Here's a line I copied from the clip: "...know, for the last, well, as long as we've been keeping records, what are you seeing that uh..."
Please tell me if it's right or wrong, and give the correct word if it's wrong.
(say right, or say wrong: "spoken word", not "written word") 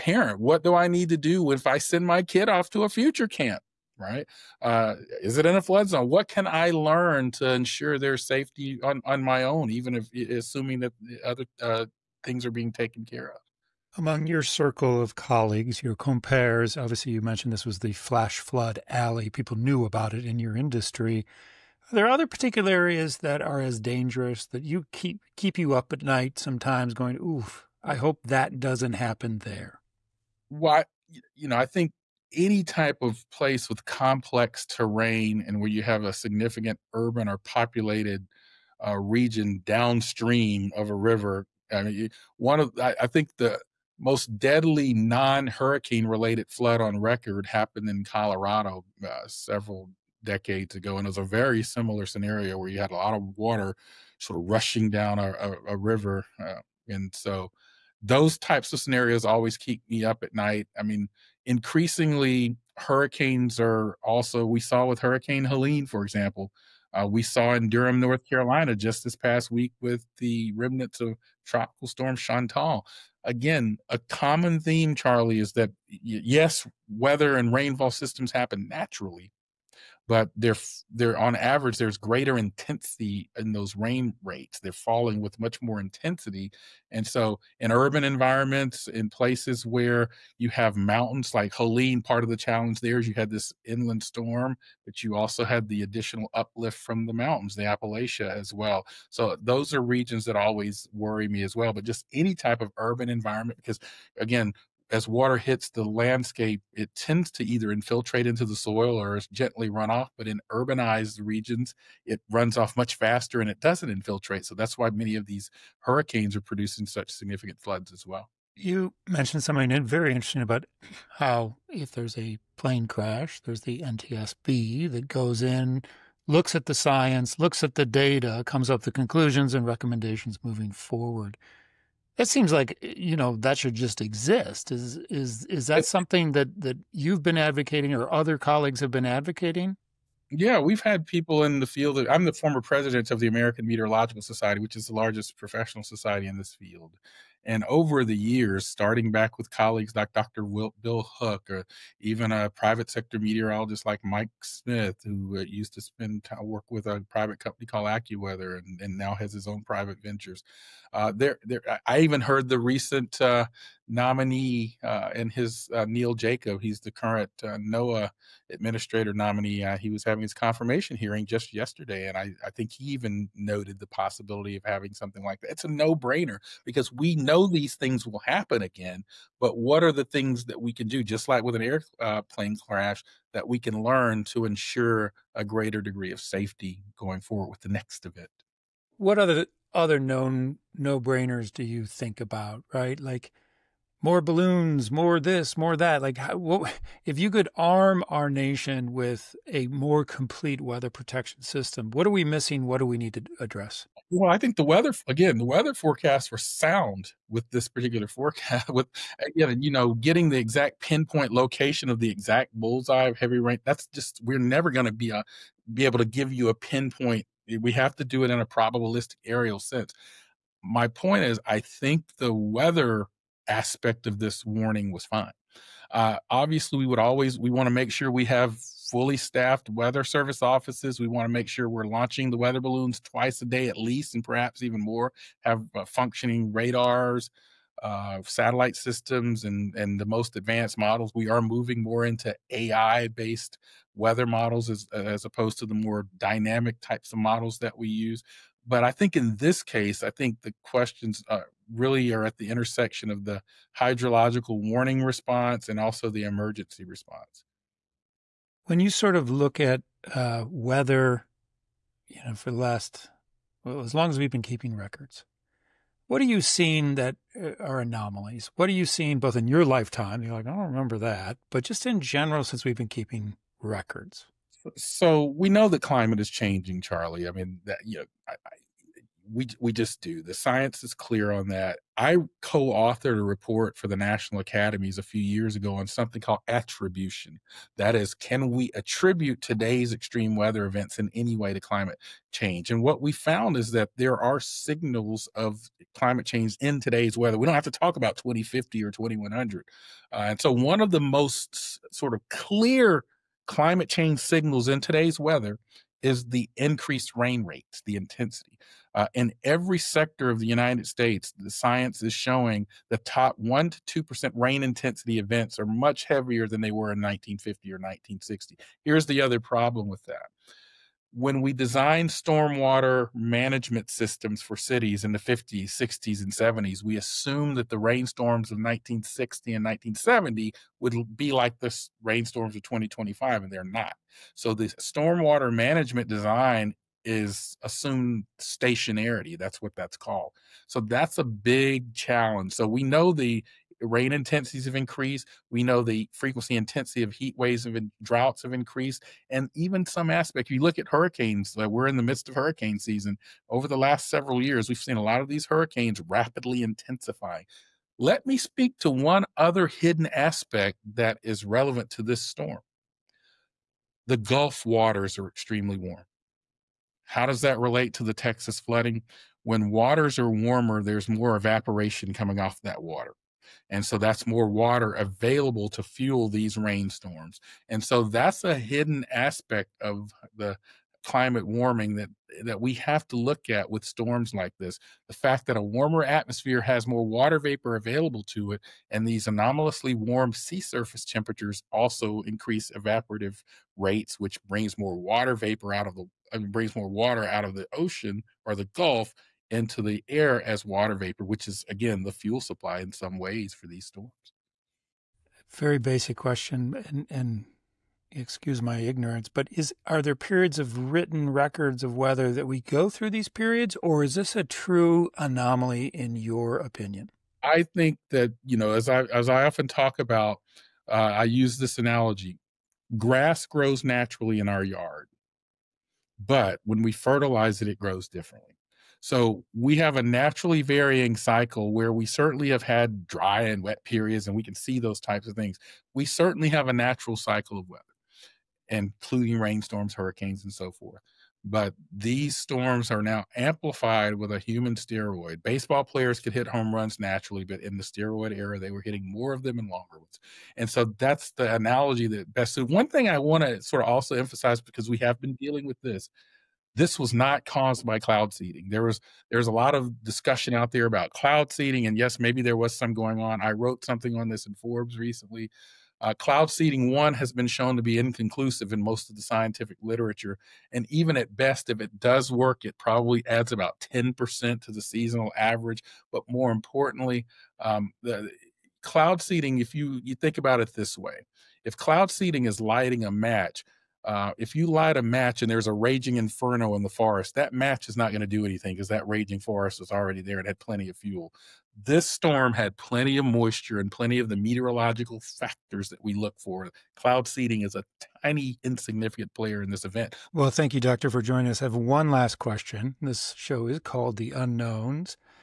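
right.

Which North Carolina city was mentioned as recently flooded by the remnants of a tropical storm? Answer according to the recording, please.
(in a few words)
Durham.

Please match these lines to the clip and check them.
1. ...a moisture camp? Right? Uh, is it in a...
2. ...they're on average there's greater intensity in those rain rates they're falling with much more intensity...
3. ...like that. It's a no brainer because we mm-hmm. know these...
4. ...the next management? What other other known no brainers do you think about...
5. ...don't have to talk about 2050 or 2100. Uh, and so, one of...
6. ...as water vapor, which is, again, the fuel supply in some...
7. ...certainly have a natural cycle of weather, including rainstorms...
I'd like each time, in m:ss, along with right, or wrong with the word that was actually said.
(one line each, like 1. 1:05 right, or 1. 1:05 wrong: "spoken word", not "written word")
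1. 0:02 wrong: "future", not "moisture"
2. 1:20 right
3. 2:55 right
4. 3:07 wrong: "event", not "management"
5. 4:57 right
6. 6:40 right
7. 7:16 right.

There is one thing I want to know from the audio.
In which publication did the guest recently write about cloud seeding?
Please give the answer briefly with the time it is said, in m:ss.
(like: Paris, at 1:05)
Forbes, at 7:44.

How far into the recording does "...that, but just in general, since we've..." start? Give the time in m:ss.
4:30.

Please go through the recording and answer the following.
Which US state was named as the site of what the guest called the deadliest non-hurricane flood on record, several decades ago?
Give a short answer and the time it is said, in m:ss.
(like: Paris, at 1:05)
Colorado, at 0:48.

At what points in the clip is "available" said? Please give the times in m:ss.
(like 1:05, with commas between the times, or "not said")
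6:14, 6:27.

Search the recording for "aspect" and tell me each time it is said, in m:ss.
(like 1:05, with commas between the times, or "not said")
3:43, 5:50, 6:00, 6:19.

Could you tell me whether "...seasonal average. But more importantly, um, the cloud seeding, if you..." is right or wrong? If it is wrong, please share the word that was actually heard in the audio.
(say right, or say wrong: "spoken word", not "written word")
right.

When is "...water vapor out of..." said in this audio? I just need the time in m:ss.
6:34.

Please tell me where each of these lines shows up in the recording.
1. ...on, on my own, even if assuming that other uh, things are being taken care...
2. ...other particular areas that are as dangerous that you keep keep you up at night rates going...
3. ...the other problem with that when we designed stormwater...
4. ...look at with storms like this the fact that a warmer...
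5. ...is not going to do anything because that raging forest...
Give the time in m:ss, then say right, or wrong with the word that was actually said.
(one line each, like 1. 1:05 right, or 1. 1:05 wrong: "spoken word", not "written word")
1. 0:08 right
2. 0:22 wrong: "sometimes", not "rates"
3. 5:19 right
4. 6:23 right
5. 8:07 right.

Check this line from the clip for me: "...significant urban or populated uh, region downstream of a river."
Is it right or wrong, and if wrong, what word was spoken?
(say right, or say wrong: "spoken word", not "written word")
right.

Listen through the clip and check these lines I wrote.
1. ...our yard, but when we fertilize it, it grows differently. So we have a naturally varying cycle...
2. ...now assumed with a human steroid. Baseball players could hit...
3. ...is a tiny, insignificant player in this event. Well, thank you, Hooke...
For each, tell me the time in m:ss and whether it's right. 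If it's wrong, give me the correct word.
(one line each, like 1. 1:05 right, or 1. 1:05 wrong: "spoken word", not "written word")
1. 7:04 right
2. 7:23 wrong: "amplified", not "assumed"
3. 8:17 wrong: "Doctor", not "Hooke".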